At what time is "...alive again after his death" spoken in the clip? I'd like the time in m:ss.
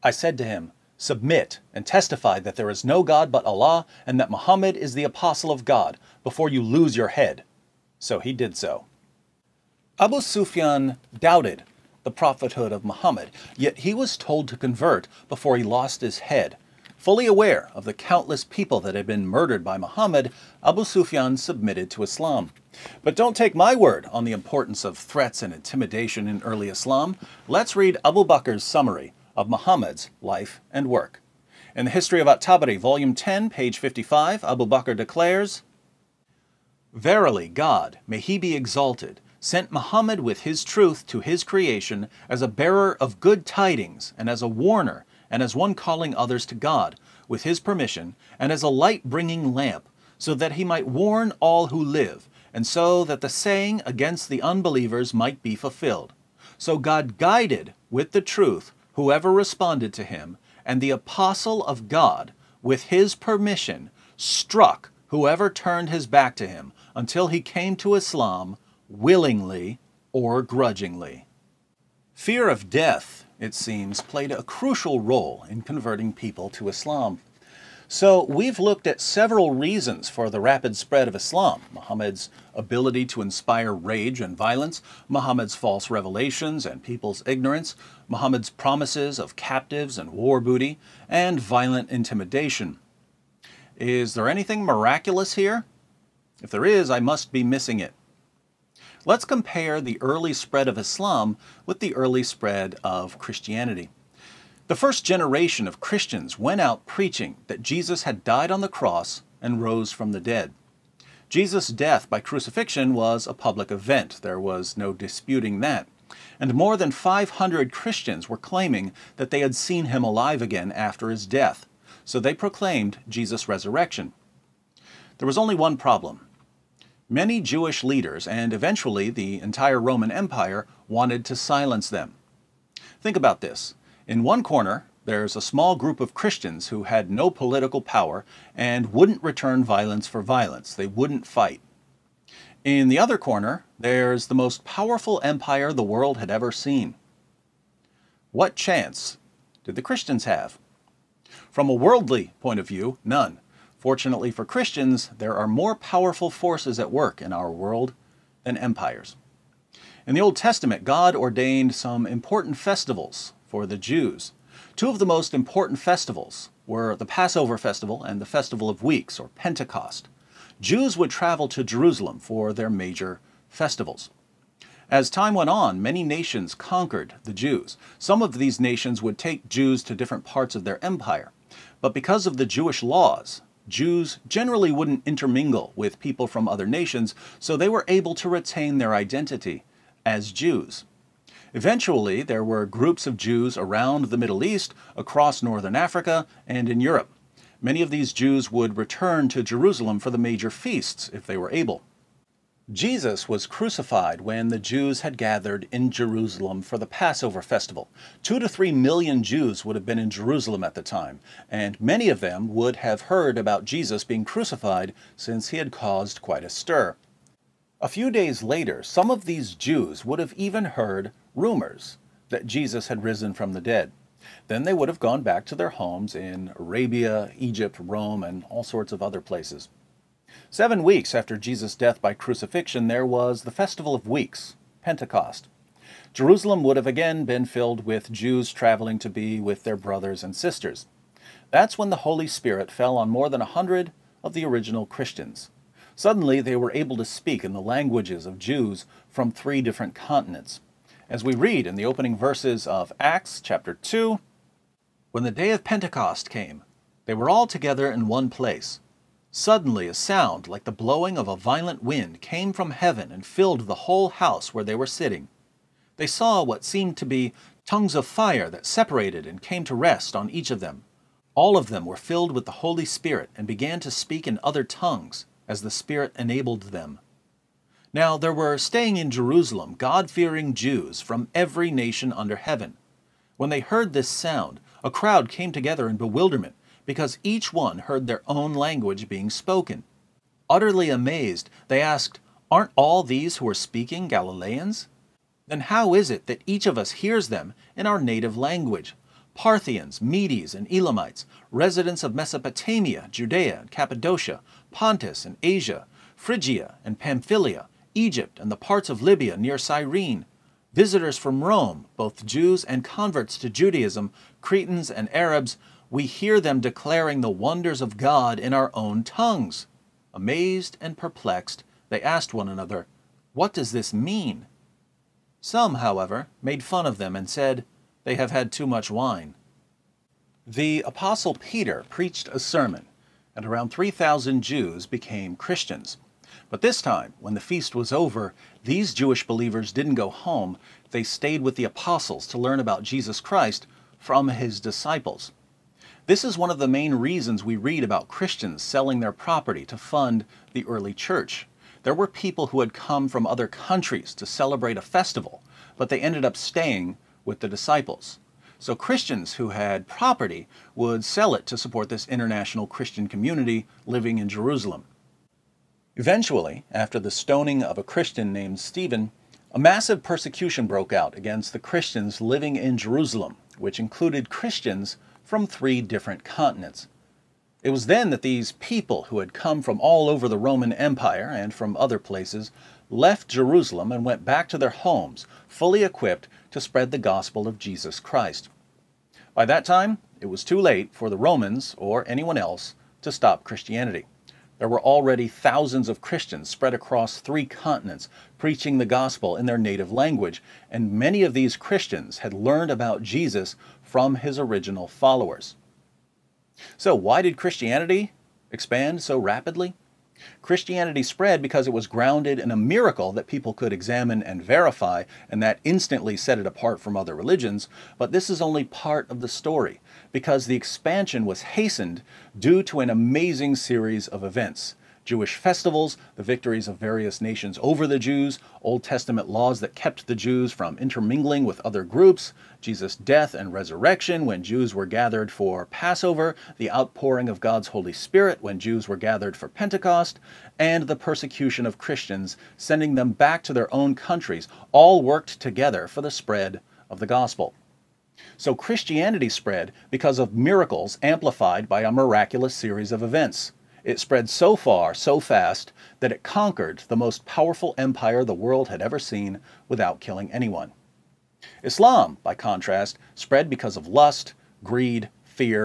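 2:00.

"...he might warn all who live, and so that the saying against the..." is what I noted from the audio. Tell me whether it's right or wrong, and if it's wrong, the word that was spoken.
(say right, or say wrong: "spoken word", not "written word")
right.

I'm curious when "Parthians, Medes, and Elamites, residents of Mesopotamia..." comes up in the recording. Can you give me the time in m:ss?
4:59.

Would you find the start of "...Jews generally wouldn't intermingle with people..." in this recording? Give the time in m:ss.
3:03.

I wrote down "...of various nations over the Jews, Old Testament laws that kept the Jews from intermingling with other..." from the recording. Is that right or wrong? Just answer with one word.
right.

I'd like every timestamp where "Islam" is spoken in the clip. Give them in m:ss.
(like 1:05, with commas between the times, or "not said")
0:22, 0:26, 1:07, 1:16, 1:21, 1:40, 7:41.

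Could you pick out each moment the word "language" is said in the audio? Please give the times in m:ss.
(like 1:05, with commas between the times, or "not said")
4:07, 4:48, 4:58, 6:39.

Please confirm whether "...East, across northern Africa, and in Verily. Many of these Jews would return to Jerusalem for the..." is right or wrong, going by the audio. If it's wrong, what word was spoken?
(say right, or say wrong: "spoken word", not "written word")
wrong: "Europe", not "Verily".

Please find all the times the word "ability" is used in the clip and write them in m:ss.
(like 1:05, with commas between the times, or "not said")
1:22.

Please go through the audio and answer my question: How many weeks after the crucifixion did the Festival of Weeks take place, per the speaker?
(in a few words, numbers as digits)
7.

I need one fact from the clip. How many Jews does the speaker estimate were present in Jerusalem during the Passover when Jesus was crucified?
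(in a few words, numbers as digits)
2 to 3 million.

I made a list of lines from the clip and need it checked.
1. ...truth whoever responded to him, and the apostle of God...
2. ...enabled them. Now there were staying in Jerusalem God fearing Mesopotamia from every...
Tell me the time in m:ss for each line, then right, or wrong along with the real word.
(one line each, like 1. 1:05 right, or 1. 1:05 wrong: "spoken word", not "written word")
1. 0:58 right
2. 4:36 wrong: "Jews", not "Mesopotamia".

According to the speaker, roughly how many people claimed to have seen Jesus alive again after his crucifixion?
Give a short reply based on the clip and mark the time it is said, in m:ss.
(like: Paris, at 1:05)
more than 500, at 1:56.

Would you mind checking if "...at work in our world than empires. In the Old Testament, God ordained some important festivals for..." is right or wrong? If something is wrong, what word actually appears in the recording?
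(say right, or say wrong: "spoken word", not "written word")
right.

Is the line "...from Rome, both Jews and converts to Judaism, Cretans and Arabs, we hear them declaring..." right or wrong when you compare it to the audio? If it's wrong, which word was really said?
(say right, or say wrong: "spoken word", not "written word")
right.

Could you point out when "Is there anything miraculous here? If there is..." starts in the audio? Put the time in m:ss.
1:33.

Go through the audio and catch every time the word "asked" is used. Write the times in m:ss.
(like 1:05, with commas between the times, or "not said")
4:51, 5:22.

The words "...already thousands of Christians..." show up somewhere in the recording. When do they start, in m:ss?
6:34.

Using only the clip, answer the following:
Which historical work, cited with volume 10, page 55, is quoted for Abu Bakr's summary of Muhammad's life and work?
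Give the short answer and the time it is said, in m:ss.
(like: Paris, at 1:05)
History of At-Tabari, at 0:31.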